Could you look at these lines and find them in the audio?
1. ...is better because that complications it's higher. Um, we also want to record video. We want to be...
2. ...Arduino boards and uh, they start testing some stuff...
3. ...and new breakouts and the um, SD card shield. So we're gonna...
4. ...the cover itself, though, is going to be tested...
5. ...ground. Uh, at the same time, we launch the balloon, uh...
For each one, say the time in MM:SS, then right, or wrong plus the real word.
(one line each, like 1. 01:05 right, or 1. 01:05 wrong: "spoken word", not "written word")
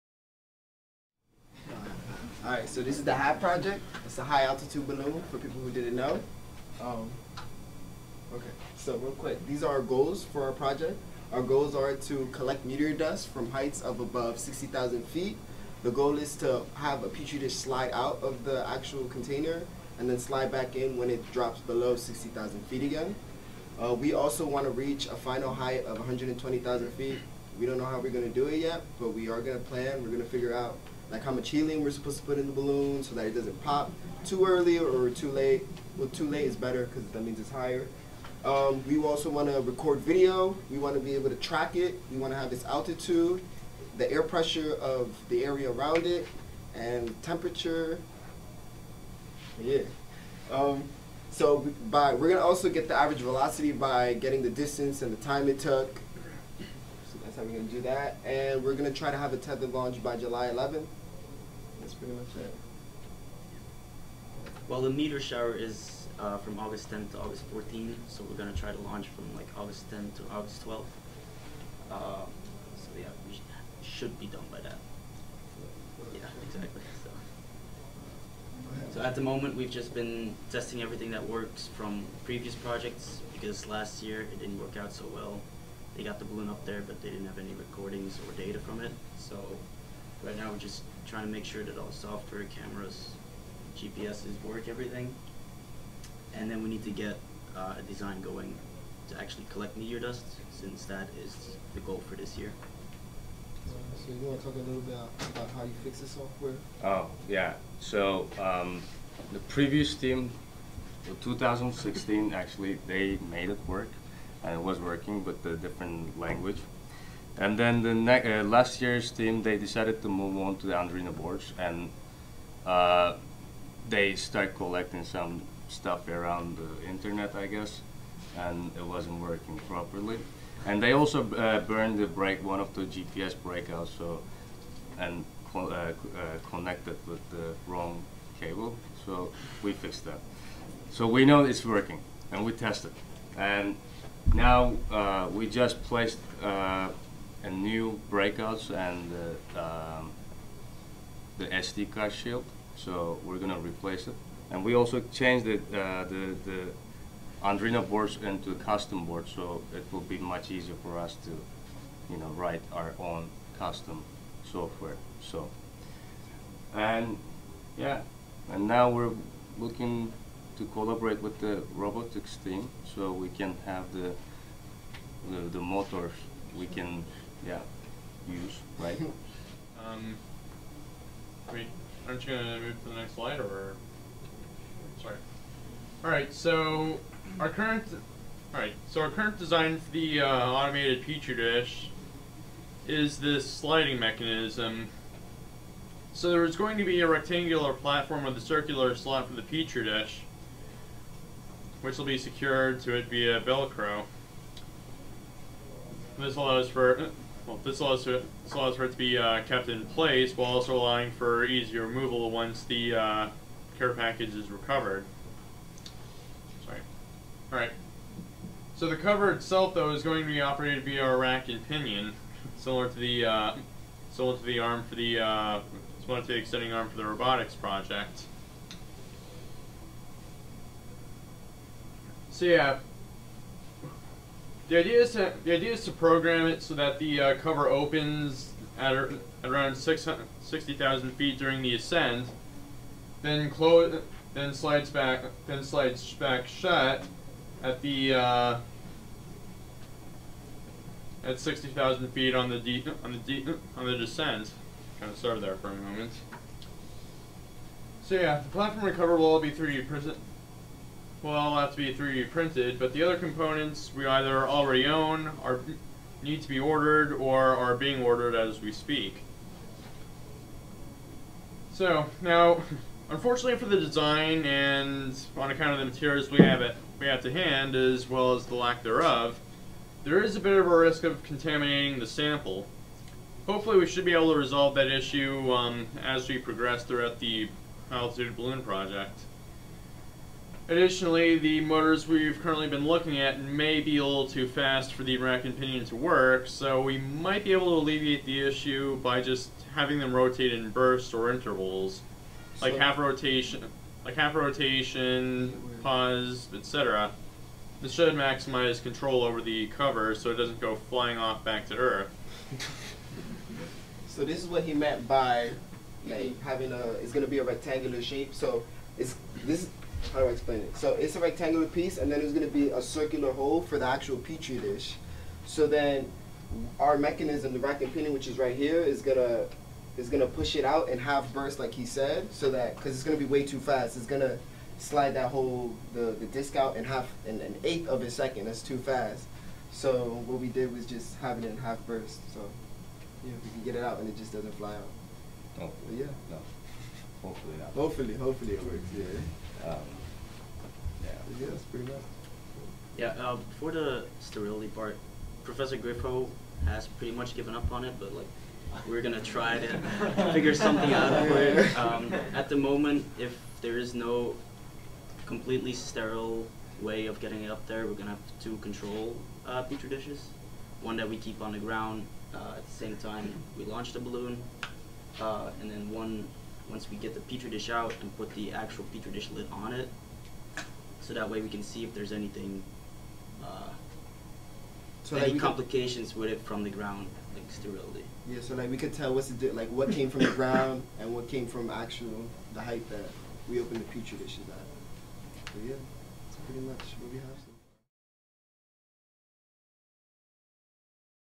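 1. 00:36 wrong: "means", not "complications"
2. 02:00 wrong: "collecting", not "testing"
3. 02:27 right
4. 03:38 wrong: "operated", not "tested"
5. 06:11 right.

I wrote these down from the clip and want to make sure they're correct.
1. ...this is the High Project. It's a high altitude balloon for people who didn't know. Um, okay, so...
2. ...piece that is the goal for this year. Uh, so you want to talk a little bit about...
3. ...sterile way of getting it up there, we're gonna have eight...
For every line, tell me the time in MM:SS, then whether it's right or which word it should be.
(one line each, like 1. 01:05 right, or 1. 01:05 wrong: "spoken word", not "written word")
1. 00:02 right
2. 01:40 wrong: "since", not "piece"
3. 06:05 wrong: "two", not "eight".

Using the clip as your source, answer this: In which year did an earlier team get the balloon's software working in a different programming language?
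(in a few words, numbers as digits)
2016.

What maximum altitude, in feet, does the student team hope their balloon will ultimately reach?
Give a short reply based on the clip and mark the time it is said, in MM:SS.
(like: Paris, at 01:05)
120,000 feet, at 00:25.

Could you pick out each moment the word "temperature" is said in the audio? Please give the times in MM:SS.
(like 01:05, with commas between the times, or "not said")
00:47.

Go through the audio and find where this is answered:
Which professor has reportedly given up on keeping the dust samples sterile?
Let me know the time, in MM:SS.
05:55.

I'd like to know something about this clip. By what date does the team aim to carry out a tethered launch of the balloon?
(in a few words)
July 11th.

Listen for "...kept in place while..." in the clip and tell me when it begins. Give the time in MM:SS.
03:29.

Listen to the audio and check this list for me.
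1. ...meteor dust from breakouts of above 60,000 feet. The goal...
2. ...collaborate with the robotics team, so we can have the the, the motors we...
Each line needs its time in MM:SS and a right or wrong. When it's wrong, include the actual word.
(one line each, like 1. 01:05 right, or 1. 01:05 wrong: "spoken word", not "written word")
1. 00:12 wrong: "heights", not "breakouts"
2. 02:50 right.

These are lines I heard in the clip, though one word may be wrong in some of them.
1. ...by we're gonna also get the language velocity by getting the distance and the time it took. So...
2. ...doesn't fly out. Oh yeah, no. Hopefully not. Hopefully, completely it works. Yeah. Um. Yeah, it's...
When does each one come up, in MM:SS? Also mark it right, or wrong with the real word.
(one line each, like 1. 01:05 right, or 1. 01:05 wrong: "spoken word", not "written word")
1. 00:51 wrong: "average", not "language"
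2. 05:44 wrong: "hopefully", not "completely".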